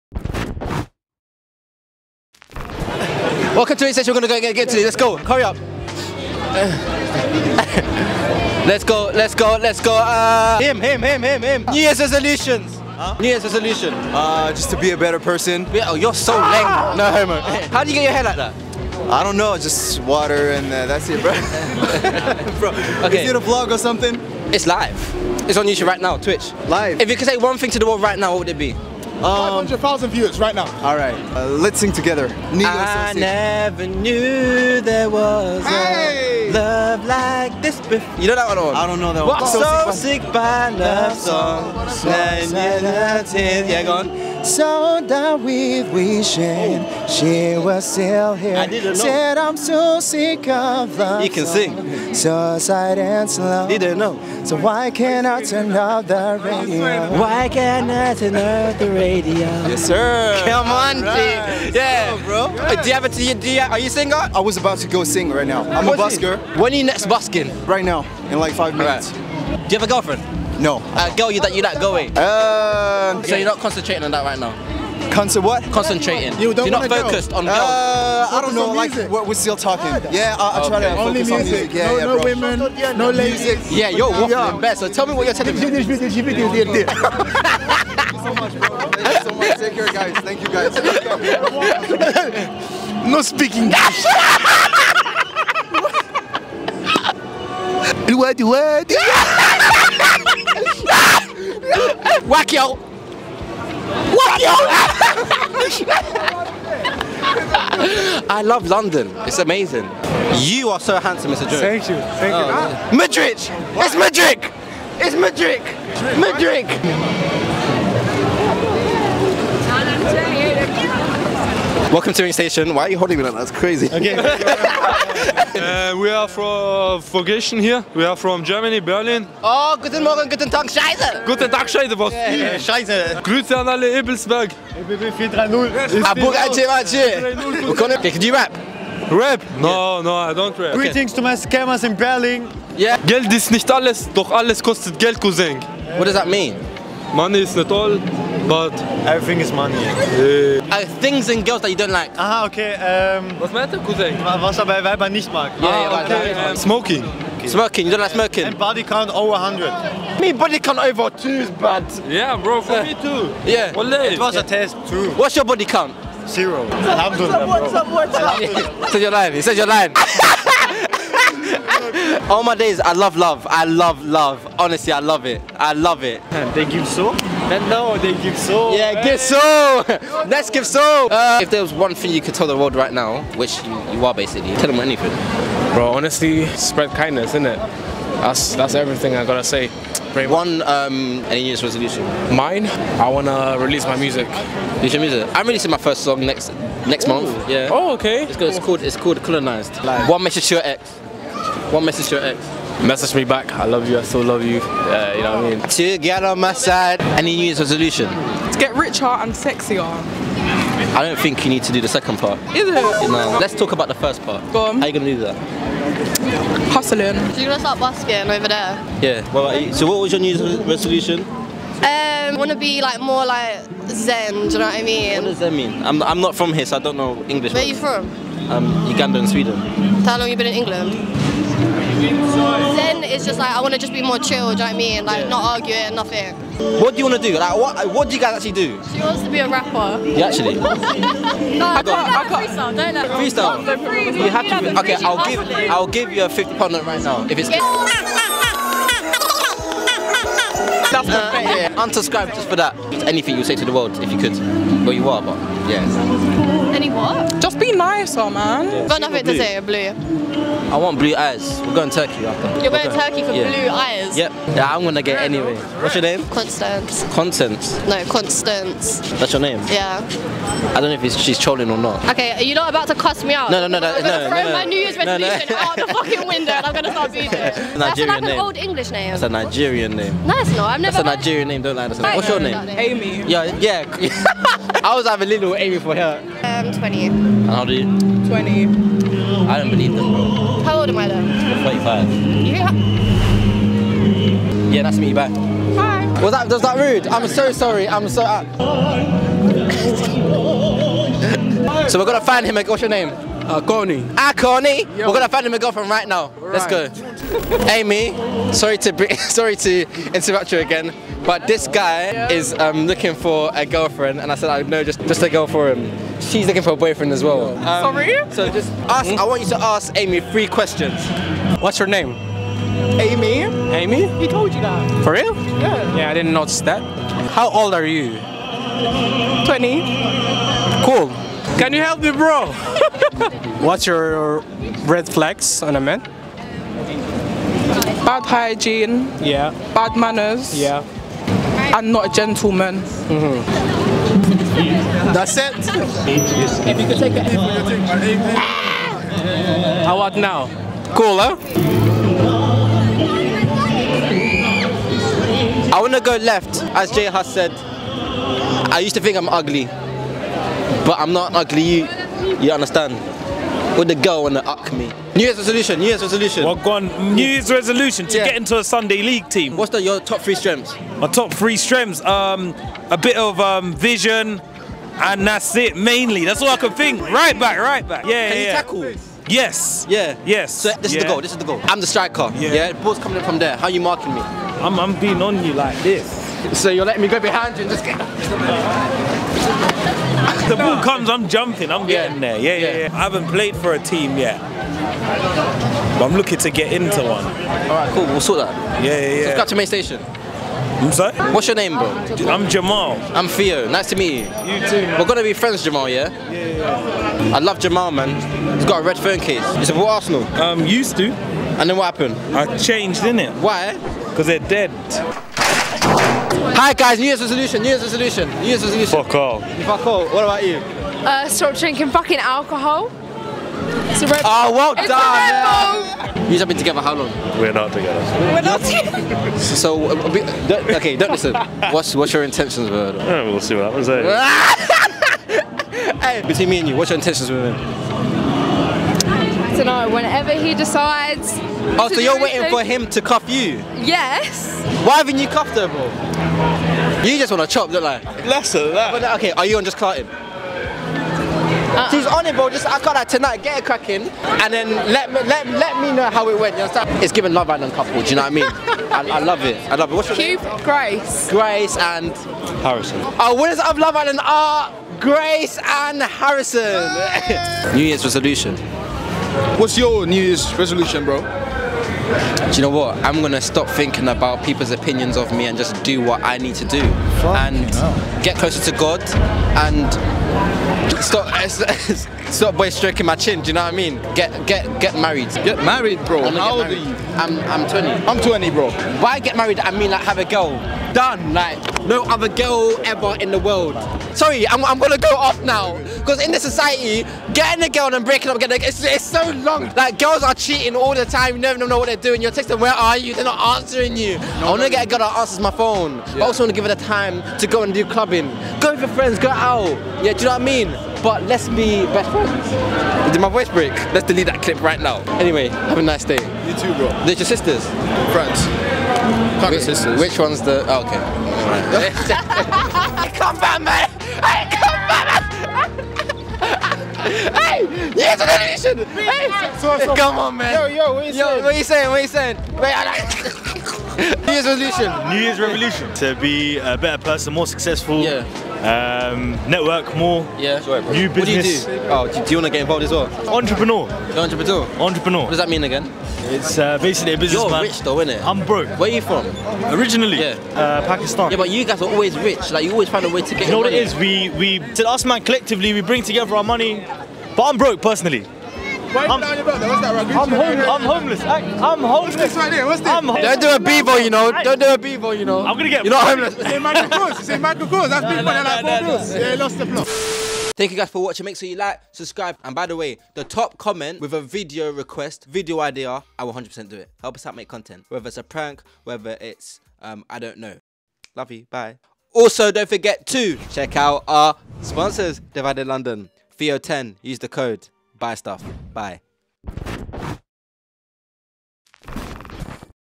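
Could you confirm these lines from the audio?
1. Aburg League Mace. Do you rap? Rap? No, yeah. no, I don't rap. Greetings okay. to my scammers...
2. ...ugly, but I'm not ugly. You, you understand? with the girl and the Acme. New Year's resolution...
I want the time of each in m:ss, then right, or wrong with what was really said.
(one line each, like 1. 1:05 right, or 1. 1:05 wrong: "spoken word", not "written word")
1. 2:16 wrong: "Ace", not "League"
2. 5:59 right.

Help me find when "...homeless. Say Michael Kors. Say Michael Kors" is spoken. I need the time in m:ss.
9:26.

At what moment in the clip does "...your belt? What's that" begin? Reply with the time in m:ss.
9:19.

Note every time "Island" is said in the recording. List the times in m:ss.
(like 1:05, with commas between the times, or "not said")
7:37, 7:43.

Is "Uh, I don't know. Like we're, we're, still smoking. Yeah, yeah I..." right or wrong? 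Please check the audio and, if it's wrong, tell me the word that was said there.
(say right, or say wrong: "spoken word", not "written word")
wrong: "talking", not "smoking".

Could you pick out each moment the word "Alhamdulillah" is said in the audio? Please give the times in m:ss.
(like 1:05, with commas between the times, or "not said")
2:46.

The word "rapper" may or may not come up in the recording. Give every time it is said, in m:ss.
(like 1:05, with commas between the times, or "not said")
3:59.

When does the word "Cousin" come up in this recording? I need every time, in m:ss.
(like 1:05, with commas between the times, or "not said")
2:25, 2:33.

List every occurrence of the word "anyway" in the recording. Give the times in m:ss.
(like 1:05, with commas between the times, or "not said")
4:25, 8:35.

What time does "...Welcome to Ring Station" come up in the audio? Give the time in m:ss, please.
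2:01.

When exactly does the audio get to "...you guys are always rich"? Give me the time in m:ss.
9:11.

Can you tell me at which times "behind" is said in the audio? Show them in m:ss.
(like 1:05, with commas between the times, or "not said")
6:27.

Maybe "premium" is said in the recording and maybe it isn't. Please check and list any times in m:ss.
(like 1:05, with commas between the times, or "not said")
not said.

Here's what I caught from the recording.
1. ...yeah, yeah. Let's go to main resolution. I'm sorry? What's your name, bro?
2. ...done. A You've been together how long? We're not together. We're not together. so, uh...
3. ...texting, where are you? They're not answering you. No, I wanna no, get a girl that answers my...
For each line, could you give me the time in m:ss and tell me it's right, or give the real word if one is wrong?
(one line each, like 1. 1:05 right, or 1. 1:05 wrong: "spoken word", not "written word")
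1. 6:38 wrong: "station", not "resolution"
2. 7:04 right
3. 8:22 right.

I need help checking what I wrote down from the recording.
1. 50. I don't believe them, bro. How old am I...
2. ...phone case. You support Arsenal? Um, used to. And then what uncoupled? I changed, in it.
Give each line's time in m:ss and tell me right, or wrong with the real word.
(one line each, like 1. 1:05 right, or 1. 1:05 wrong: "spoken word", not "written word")
1. 4:48 wrong: "20", not "50"
2. 6:48 wrong: "happened", not "uncoupled".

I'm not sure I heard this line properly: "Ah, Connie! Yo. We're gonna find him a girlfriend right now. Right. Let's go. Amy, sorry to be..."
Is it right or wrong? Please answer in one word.
right.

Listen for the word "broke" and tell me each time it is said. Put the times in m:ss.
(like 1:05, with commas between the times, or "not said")
9:08, 9:17.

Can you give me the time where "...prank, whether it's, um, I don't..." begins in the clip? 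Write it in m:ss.
9:38.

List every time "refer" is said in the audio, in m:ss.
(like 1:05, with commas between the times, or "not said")
not said.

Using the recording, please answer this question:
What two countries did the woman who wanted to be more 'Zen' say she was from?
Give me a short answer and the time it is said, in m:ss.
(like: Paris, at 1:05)
Uganda and Sweden, at 3:48.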